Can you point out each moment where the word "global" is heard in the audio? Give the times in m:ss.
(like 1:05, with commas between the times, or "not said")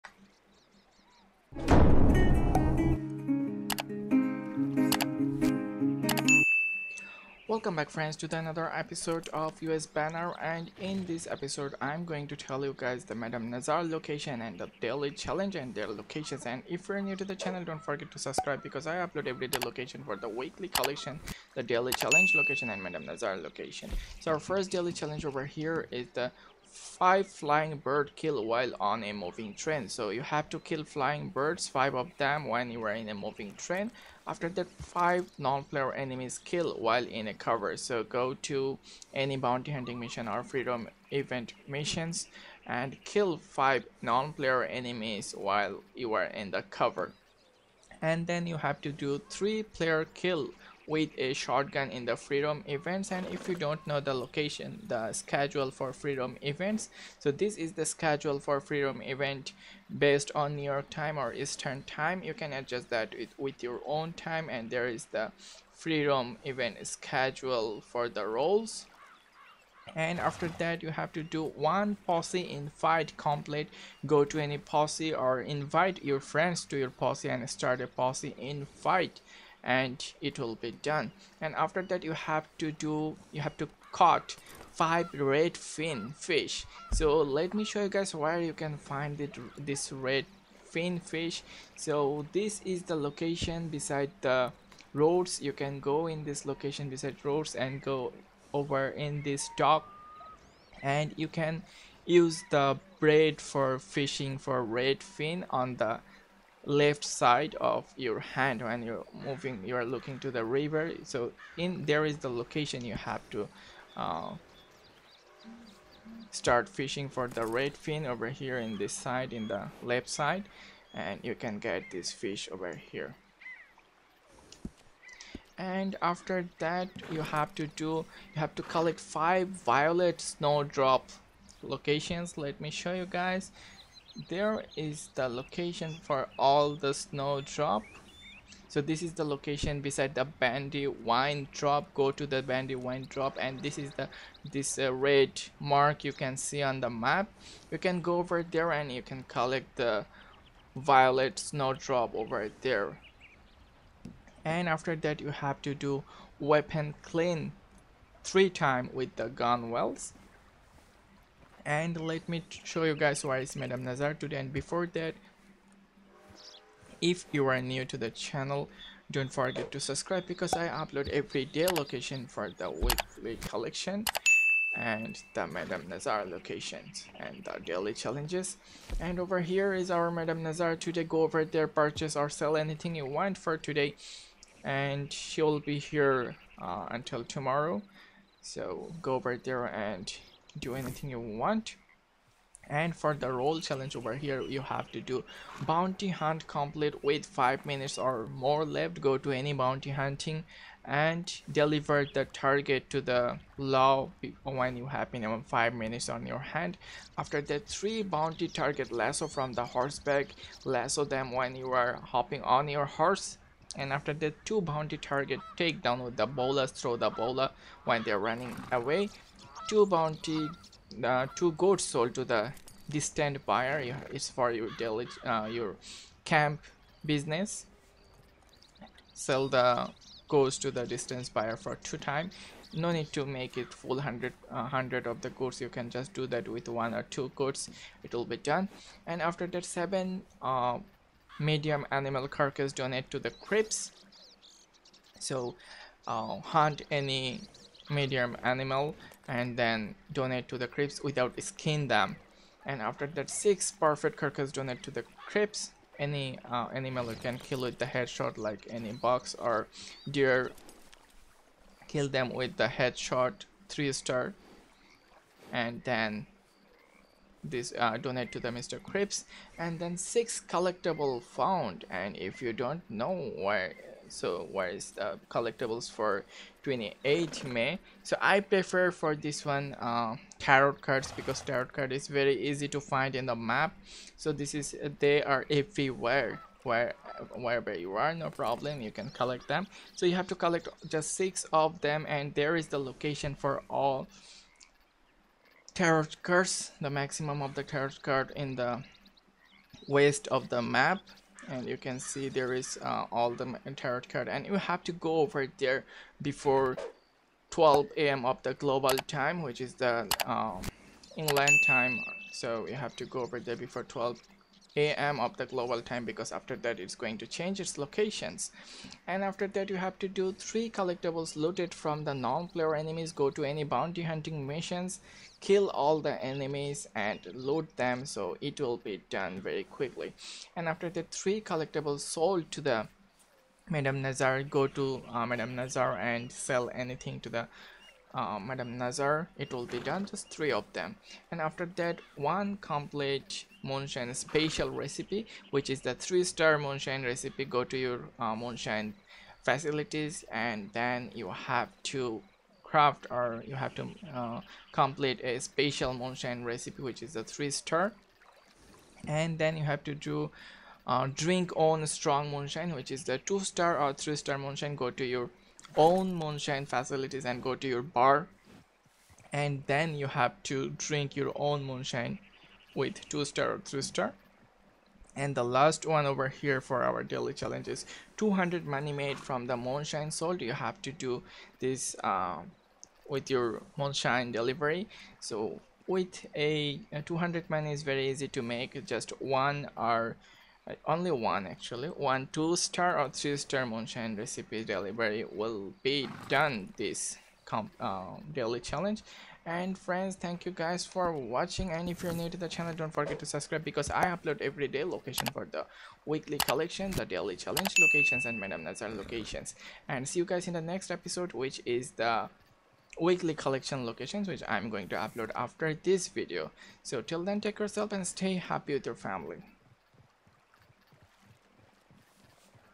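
5:08, 5:15.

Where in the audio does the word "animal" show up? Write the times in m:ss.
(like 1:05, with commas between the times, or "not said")
4:01, 4:08, 4:16.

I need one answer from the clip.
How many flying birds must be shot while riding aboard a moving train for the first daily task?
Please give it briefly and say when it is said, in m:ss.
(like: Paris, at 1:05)
5, at 0:31.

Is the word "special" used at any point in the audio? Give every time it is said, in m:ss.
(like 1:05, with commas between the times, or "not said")
5:44, 5:55.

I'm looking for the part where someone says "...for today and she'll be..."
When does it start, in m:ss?
3:03.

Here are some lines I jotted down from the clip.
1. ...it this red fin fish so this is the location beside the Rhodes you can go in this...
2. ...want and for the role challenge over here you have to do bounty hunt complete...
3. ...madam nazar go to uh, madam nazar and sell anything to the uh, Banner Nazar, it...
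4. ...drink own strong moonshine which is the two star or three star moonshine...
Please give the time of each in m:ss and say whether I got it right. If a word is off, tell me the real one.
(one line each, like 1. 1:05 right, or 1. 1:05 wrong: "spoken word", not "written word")
1. 1:29 right
2. 3:11 right
3. 5:33 wrong: "Madam", not "Banner"
4. 6:01 right.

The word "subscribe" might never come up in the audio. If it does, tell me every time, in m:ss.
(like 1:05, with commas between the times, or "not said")
0:18, 2:49, 6:43.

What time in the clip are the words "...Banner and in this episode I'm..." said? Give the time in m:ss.
0:09.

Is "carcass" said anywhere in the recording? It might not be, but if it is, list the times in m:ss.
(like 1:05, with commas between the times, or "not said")
4:02, 4:14.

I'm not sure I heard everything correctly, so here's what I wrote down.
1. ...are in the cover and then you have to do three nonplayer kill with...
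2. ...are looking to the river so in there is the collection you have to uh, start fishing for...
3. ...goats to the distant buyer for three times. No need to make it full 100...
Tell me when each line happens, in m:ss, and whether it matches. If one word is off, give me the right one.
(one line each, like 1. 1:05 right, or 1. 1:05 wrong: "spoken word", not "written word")
1. 0:46 wrong: "player", not "nonplayer"
2. 1:49 wrong: "location", not "collection"
3. 3:50 wrong: "two", not "three".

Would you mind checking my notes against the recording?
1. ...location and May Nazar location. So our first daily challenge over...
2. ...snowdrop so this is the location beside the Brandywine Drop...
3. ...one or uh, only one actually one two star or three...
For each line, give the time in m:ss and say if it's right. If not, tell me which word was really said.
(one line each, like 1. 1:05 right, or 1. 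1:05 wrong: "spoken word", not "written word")
1. 0:22 wrong: "Madam", not "May"
2. 2:16 right
3. 6:29 right.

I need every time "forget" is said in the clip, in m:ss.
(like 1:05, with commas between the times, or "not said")
0:17, 2:49, 6:42.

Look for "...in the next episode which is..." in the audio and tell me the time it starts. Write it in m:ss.
6:50.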